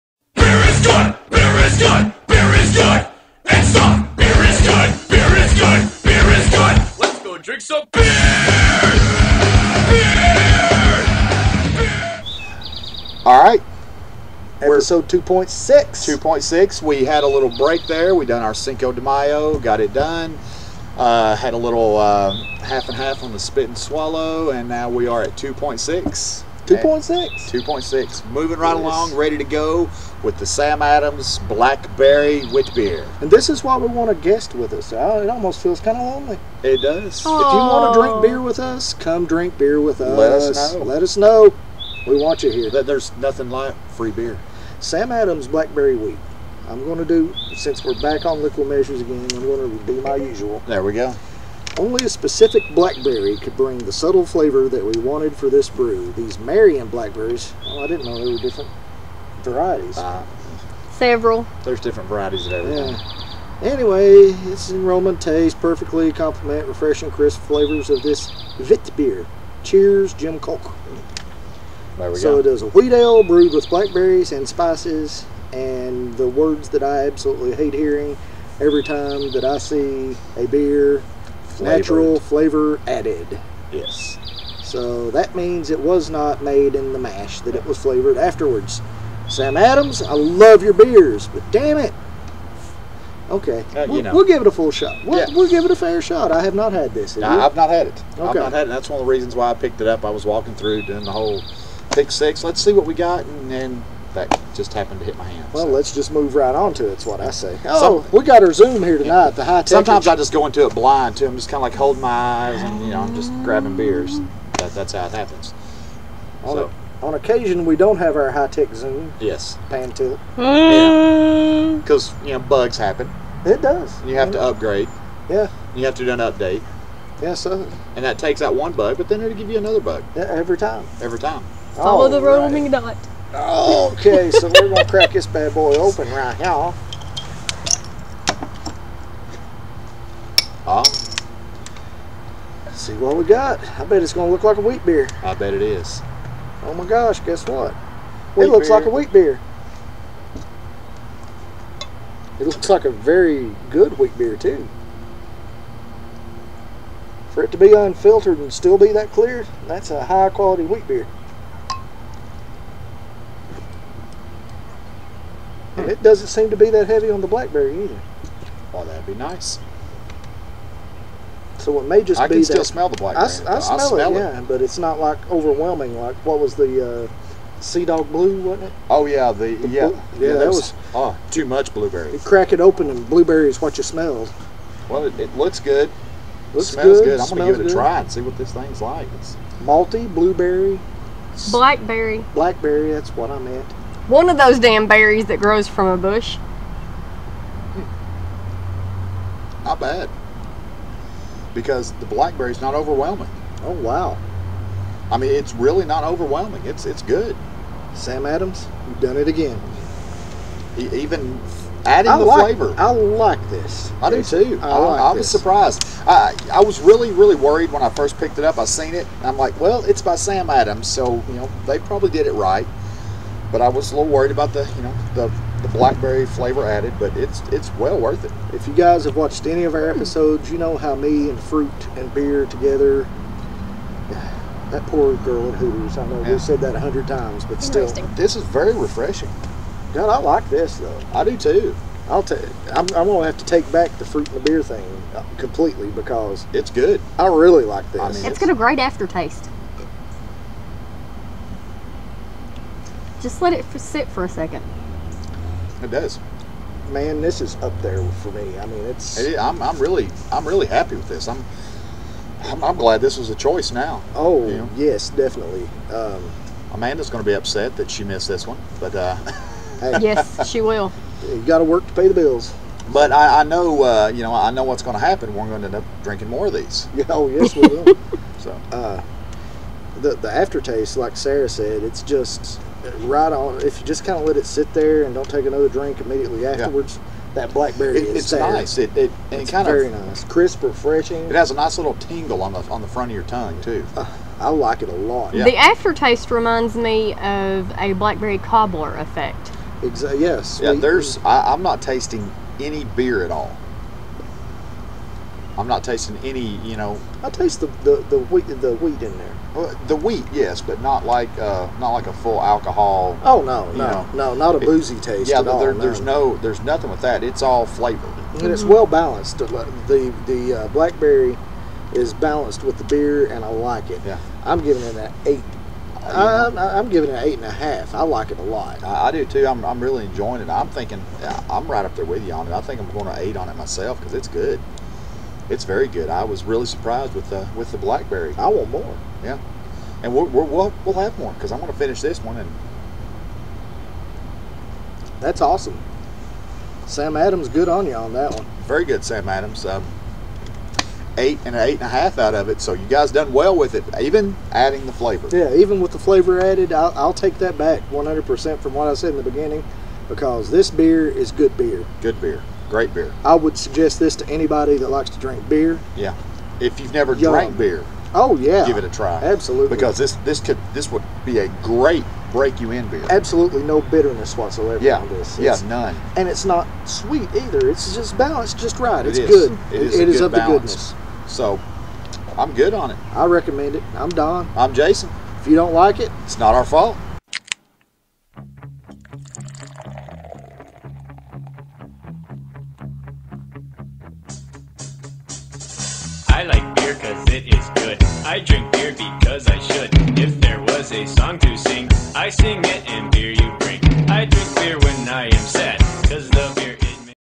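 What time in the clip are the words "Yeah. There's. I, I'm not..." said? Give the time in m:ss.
5:00.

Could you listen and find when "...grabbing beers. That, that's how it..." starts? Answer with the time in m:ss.
1:53.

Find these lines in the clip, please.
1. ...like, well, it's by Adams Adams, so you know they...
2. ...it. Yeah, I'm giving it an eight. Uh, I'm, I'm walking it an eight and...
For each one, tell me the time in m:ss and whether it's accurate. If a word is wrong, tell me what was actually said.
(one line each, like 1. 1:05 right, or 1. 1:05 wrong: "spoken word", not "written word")
1. 3:39 wrong: "Sam", not "Adams"
2. 5:23 wrong: "giving", not "walking".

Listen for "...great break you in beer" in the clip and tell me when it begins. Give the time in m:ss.
6:11.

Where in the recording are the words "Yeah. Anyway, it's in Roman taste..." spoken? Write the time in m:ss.
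1:02.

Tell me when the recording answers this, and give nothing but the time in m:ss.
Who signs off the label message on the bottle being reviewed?
1:10.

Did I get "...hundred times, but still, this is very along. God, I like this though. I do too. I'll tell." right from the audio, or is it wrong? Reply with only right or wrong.
wrong.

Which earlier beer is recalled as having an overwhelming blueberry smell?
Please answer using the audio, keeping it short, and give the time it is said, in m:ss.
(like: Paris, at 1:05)
Sea Dog Blue, at 2:57.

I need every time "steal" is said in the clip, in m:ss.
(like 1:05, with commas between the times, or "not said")
not said.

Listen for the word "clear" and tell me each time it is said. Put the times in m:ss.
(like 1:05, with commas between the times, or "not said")
2:39.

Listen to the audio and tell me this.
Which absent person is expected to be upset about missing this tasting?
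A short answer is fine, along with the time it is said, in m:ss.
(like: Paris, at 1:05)
Amanda, at 4:26.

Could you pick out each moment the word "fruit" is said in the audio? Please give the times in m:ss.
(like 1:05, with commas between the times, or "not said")
3:51, 4:04.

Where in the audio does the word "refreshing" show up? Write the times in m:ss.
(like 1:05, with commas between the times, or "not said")
1:06, 3:58, 4:50.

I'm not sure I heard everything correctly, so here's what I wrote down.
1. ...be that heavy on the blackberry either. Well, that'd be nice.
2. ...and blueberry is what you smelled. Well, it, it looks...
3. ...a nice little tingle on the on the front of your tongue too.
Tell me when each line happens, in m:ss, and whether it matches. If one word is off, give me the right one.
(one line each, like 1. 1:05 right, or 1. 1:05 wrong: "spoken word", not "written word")
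1. 2:46 right
2. 3:02 right
3. 4:51 right.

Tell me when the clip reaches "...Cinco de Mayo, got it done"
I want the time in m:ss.
0:18.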